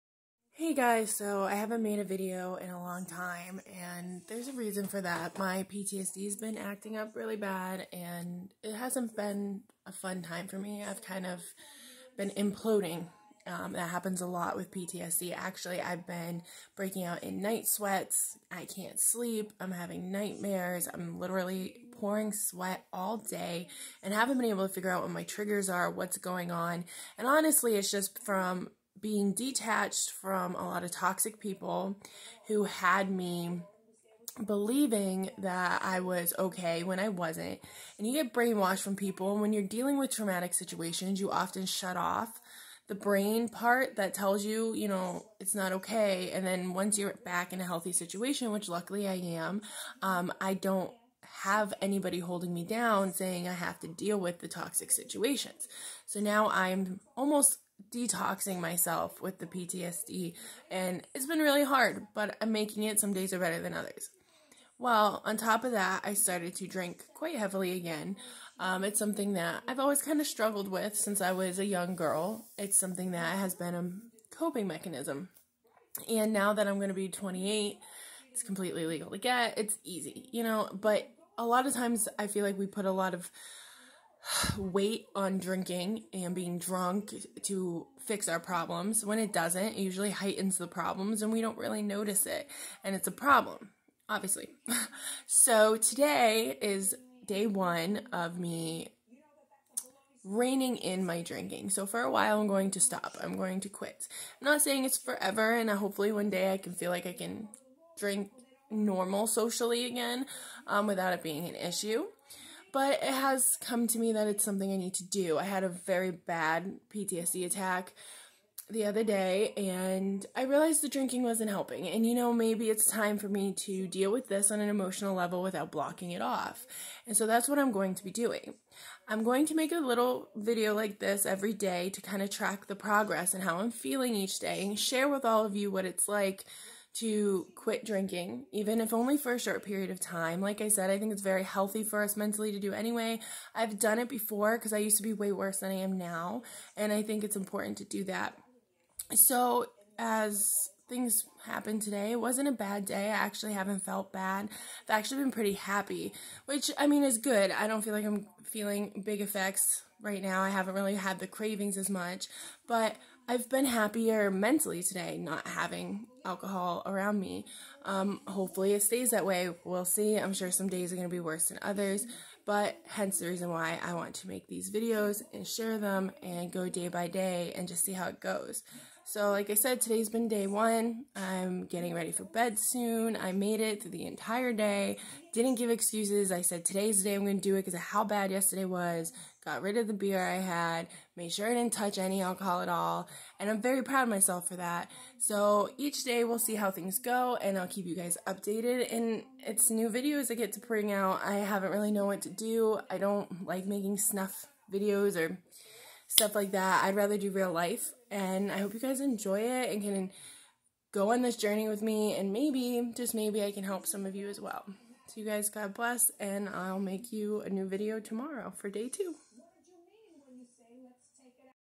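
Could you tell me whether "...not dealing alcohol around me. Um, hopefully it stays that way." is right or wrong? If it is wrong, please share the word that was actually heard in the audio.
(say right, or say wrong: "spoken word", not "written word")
wrong: "having", not "dealing".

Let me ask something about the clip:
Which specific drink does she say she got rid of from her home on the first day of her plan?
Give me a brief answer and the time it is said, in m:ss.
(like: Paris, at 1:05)
beer, at 3:09.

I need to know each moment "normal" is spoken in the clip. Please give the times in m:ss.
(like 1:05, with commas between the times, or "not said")
1:48.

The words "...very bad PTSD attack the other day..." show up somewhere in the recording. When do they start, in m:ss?
1:55.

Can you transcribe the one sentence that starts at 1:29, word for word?
When it doesn't, it usually heightens the problems and we don't really notice it.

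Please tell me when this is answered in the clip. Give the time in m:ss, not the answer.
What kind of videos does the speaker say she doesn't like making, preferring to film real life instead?
3:23.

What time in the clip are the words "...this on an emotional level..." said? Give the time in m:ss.
2:04.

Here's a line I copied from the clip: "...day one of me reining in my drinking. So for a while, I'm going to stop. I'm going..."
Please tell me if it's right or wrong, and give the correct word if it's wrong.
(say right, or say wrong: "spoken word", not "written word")
right.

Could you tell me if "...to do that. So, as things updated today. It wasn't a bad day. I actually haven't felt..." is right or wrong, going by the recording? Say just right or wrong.
wrong.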